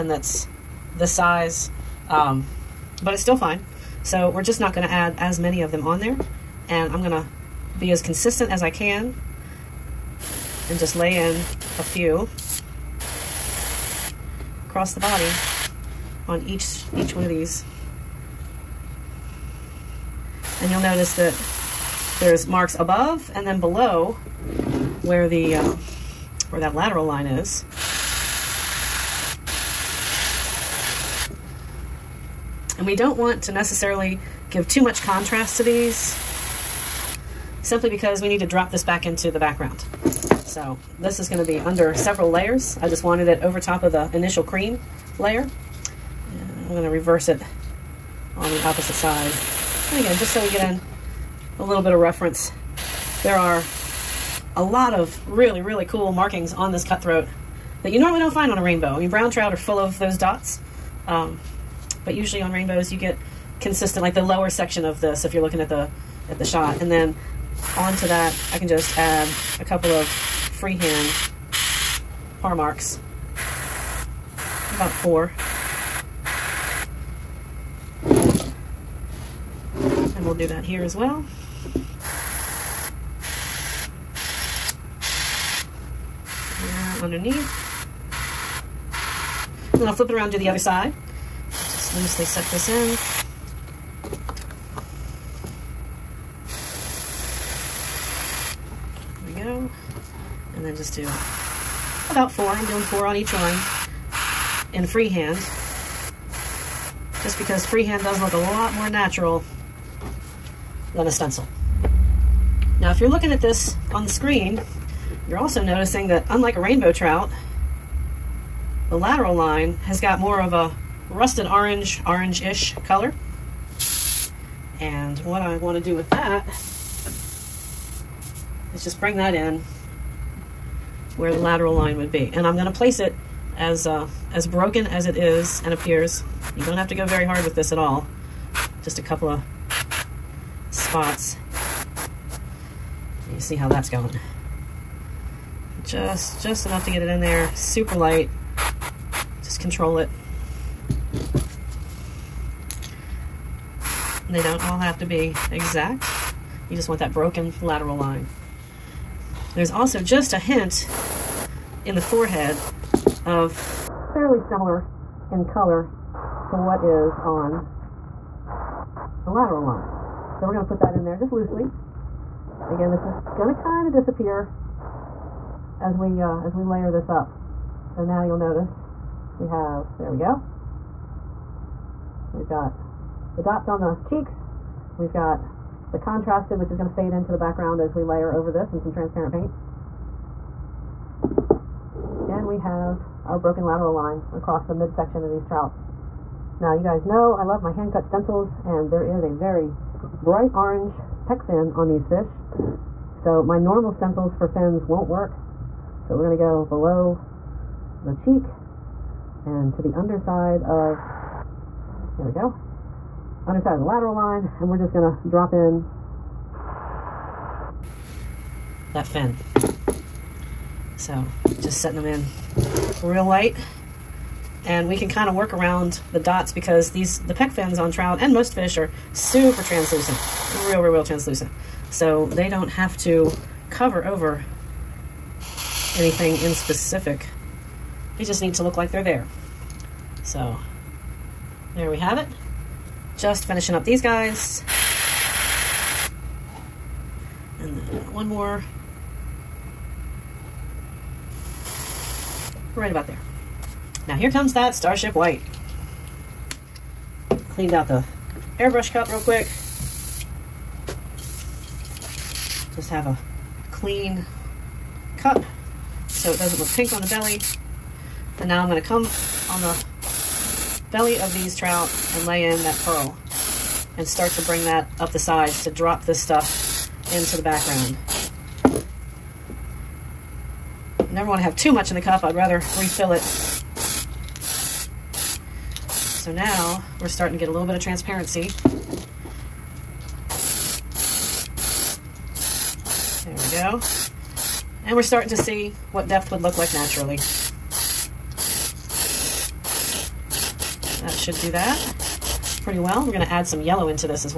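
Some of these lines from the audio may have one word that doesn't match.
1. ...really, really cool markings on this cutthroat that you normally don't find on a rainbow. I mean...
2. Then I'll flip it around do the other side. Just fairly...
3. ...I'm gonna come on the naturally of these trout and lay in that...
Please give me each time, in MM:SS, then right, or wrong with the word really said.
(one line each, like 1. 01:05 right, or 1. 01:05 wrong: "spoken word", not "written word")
1. 00:55 right
2. 01:29 wrong: "loosely", not "fairly"
3. 04:28 wrong: "belly", not "naturally".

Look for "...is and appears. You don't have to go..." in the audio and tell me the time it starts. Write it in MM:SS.
02:15.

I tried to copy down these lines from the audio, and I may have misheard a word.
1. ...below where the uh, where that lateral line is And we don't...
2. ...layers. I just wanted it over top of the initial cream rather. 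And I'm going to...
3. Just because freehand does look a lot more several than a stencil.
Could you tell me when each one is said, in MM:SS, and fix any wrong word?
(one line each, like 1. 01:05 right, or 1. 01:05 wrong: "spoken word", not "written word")
1. 00:23 right
2. 00:42 wrong: "layer", not "rather"
3. 01:47 wrong: "natural", not "several".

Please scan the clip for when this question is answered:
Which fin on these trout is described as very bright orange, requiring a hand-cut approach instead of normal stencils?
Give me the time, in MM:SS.
03:21.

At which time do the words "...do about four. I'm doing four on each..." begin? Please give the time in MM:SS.
01:40.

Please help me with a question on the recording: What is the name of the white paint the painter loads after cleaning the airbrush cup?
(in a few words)
Starship White.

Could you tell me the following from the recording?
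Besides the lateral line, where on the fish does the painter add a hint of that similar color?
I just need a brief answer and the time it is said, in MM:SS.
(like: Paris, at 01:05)
forehead, at 02:42.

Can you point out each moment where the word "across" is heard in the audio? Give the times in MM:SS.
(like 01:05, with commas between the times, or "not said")
00:14, 03:14.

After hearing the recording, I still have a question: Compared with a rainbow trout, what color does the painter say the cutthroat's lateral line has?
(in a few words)
rusted orange.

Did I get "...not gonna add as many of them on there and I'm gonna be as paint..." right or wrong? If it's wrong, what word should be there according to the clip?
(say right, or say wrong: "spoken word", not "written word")
wrong: "consistent", not "paint".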